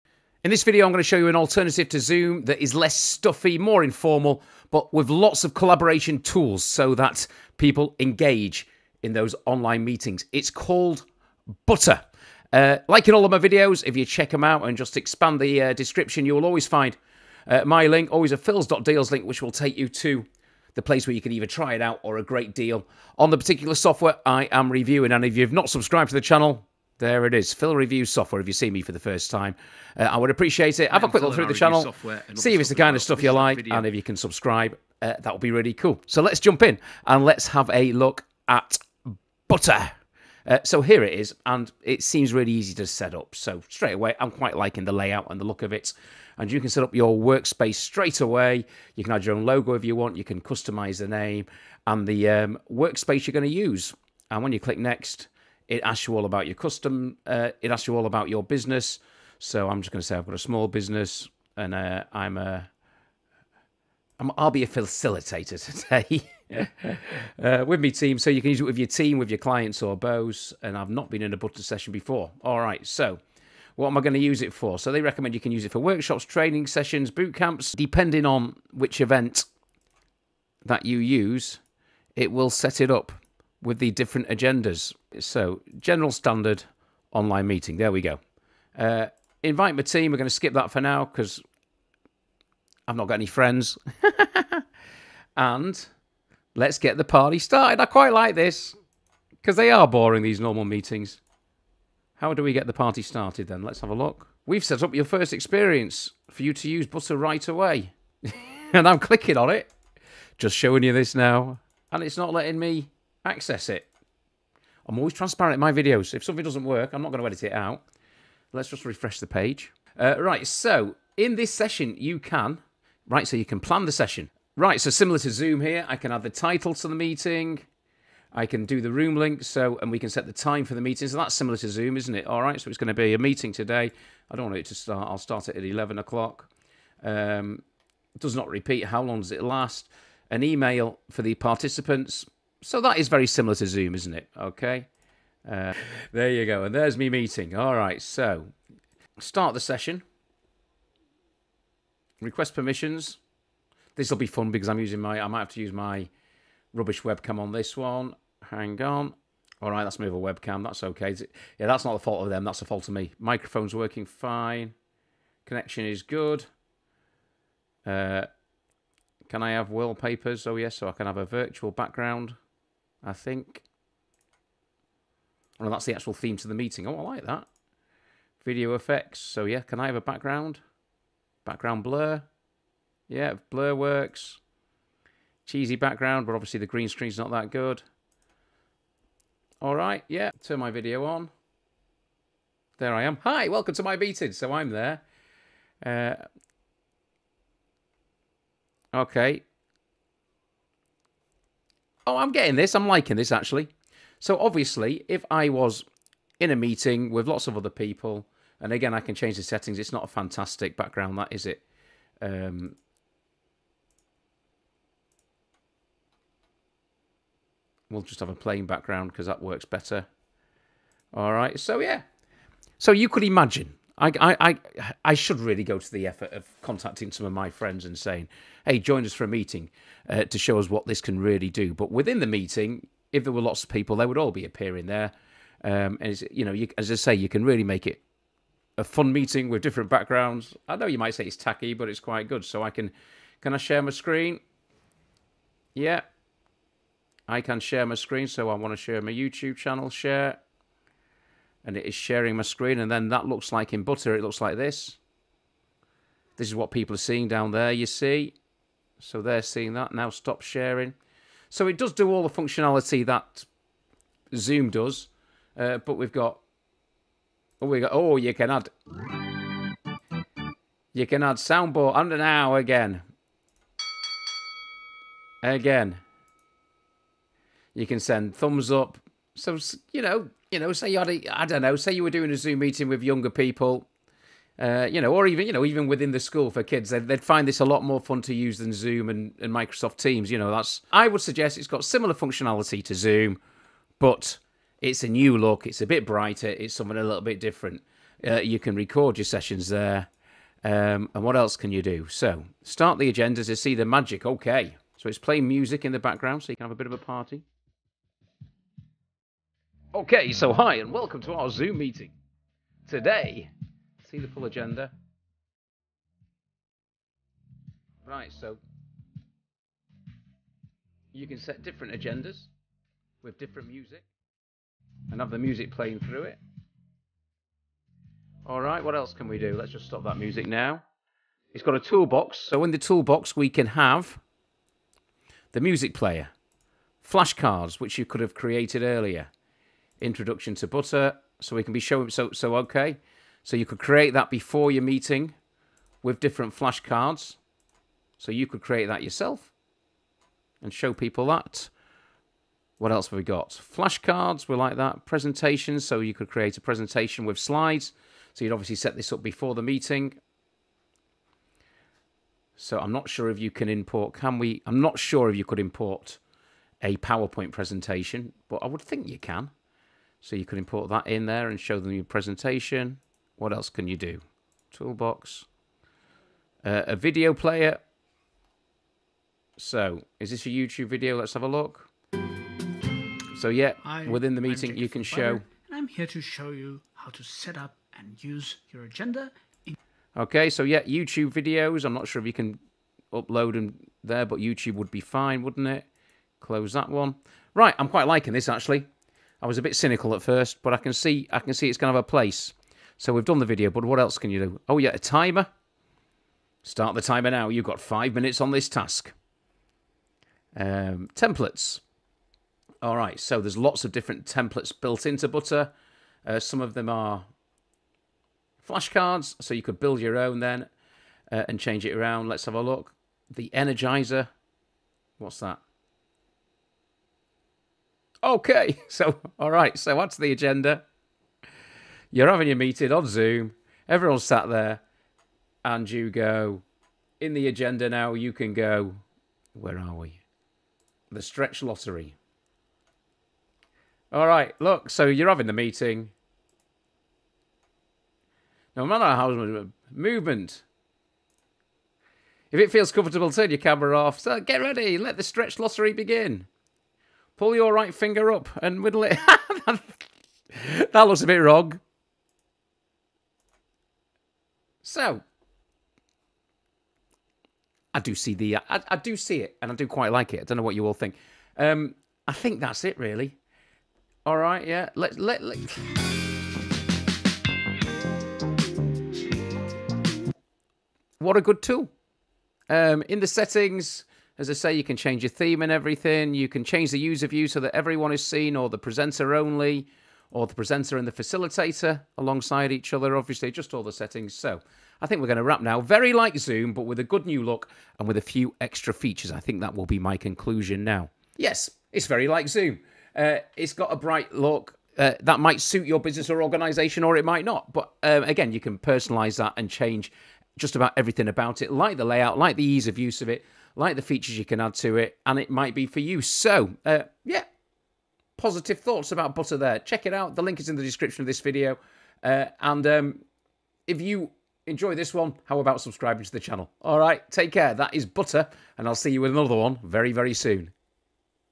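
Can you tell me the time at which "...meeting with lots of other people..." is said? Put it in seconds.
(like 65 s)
206 s.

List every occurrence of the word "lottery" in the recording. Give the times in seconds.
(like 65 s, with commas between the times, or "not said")
441 s, 455 s.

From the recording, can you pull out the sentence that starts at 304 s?
So, it's playing music in the background so you can have a bit of a party.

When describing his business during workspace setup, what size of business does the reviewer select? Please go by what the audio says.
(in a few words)
Small business.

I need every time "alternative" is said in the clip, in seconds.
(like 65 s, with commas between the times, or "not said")
1 s.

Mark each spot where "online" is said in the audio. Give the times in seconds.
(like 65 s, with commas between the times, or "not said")
9 s, 87 s.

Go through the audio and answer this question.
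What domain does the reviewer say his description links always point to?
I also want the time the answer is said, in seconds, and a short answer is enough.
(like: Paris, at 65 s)
phils.deals, at 18 s.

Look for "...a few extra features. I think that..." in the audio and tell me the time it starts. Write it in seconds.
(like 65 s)
498 s.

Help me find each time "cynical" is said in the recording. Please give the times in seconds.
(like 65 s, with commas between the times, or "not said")
399 s.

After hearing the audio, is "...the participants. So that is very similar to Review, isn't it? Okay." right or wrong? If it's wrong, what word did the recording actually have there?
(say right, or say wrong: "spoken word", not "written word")
wrong: "Zoom", not "Review".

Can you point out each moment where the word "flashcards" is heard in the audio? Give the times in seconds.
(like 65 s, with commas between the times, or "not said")
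337 s, 346 s, 353 s, 418 s.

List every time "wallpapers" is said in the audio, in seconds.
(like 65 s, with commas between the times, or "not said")
169 s.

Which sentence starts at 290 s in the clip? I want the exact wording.
You know, that's I would suggest it's got similar functionality to Zoom, but it's a new look.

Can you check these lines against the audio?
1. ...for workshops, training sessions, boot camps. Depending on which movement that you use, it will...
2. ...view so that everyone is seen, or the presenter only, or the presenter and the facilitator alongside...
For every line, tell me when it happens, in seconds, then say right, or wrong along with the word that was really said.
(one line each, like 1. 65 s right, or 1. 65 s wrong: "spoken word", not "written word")
1. 75 s wrong: "event", not "movement"
2. 487 s right.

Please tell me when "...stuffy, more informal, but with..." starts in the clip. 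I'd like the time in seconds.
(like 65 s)
2 s.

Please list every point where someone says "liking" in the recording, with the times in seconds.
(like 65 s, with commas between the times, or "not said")
44 s, 202 s, 398 s.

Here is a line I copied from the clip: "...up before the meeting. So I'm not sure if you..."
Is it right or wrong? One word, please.
right.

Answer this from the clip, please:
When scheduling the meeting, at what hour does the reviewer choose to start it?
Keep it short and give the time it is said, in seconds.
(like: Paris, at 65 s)
11 o'clock, at 135 s.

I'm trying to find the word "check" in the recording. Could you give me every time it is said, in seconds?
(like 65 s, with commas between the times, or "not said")
14 s, 519 s.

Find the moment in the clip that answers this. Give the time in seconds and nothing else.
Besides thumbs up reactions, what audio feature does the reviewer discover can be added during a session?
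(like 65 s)
271 s.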